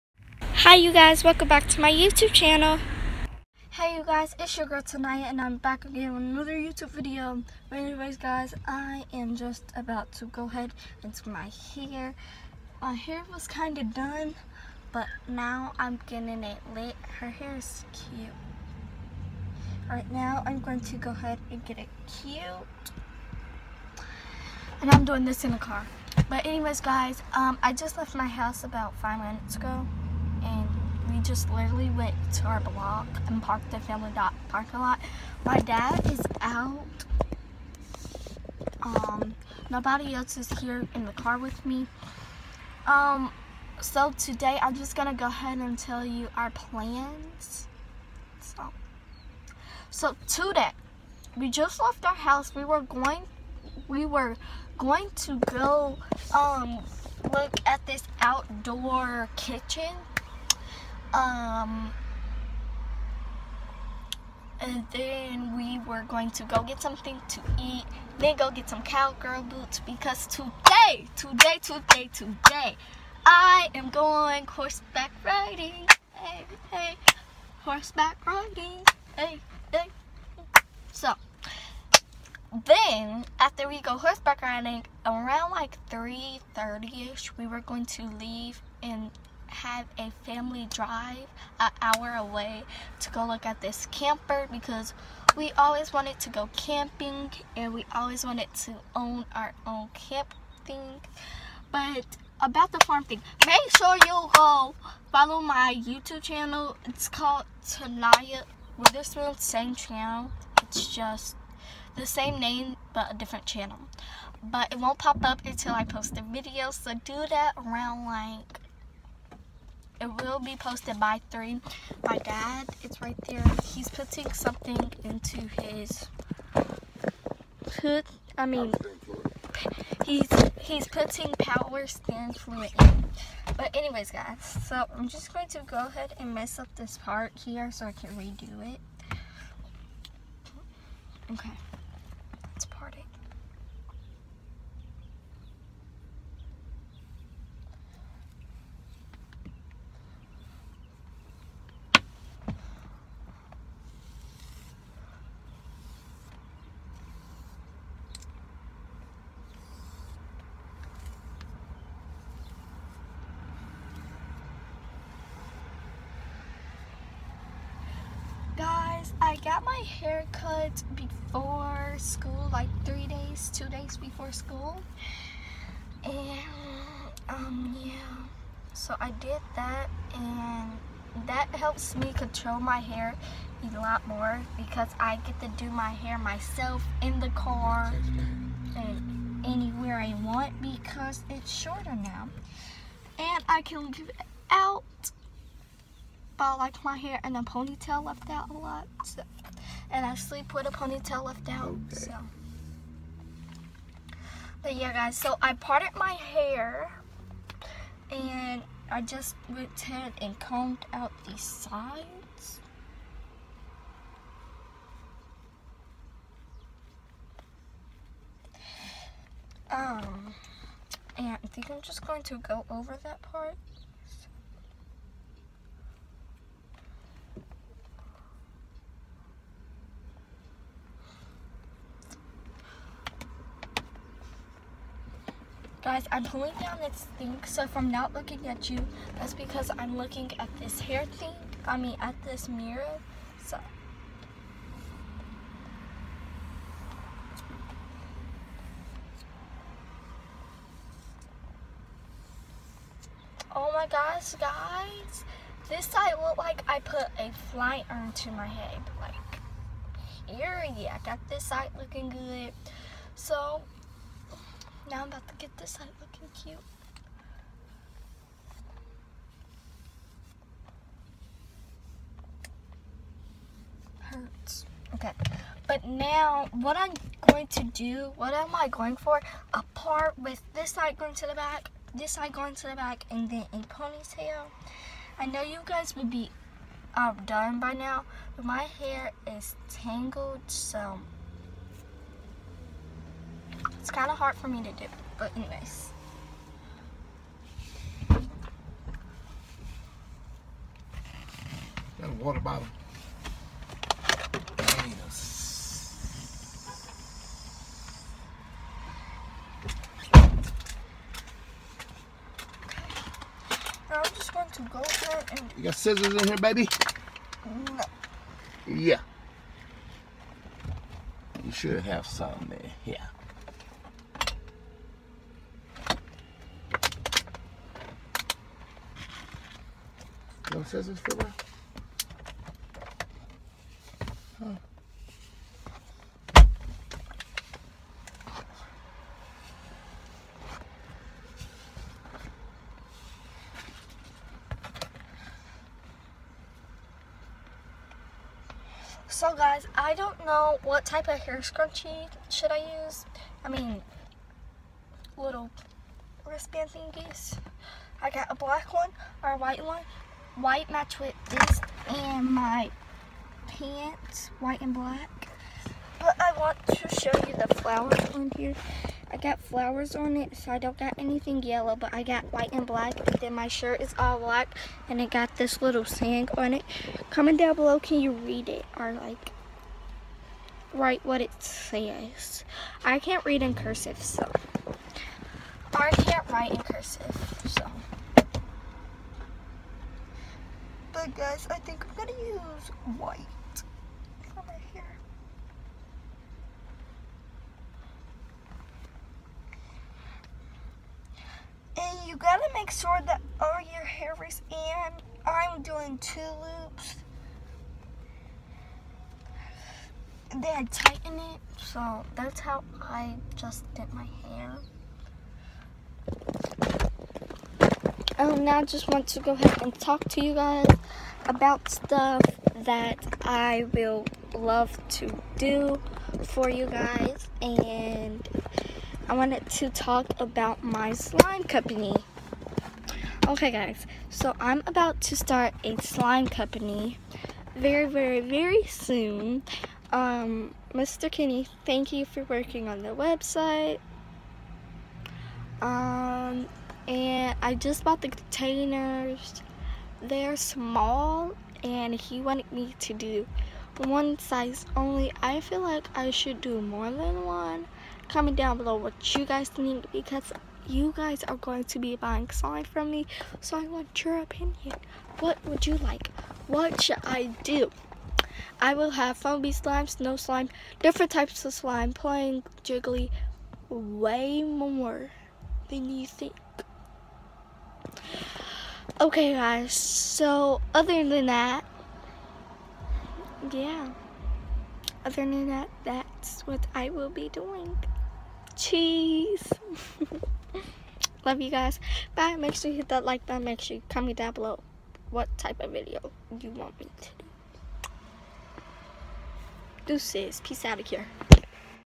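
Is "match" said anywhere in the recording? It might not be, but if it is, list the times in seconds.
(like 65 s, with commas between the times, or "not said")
360 s.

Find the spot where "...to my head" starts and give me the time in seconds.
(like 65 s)
258 s.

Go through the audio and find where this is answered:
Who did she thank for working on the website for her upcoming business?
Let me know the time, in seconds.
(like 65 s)
440 s.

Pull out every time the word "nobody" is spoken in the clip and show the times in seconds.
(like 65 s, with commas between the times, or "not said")
39 s.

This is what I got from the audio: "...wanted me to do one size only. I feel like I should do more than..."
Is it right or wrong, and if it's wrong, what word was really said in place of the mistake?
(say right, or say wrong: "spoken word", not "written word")
right.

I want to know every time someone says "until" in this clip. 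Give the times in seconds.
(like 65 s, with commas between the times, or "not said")
115 s.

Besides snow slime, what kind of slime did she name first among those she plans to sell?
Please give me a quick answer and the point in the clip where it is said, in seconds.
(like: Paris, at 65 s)
foamy slime, at 469 s.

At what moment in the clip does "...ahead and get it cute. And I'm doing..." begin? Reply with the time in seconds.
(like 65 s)
21 s.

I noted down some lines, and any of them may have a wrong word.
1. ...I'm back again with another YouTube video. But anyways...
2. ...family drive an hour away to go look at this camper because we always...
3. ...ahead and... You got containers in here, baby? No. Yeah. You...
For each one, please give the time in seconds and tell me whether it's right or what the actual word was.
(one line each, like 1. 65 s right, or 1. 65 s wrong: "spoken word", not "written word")
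1. 5 s right
2. 90 s right
3. 314 s wrong: "scissors", not "containers".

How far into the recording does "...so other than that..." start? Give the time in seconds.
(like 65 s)
479 s.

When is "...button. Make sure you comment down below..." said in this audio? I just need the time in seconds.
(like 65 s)
493 s.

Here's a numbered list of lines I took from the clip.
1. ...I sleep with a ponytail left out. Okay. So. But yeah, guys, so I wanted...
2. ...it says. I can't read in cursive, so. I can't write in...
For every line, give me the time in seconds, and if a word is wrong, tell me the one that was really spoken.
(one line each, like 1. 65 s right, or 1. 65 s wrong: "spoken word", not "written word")
1. 200 s wrong: "parted", not "wanted"
2. 381 s right.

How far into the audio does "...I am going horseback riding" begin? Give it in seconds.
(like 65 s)
73 s.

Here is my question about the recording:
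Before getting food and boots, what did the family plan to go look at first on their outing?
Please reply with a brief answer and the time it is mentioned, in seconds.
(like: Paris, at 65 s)
outdoor kitchen, at 58 s.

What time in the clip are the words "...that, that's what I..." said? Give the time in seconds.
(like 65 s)
485 s.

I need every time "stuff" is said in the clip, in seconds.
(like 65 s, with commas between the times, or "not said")
421 s.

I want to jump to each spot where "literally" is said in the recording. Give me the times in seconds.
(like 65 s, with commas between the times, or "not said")
31 s.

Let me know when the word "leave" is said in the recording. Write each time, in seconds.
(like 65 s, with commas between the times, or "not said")
88 s, 193 s.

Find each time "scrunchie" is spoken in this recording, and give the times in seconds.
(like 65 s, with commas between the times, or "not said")
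351 s.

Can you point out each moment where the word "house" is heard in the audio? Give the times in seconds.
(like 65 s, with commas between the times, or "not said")
28 s, 52 s.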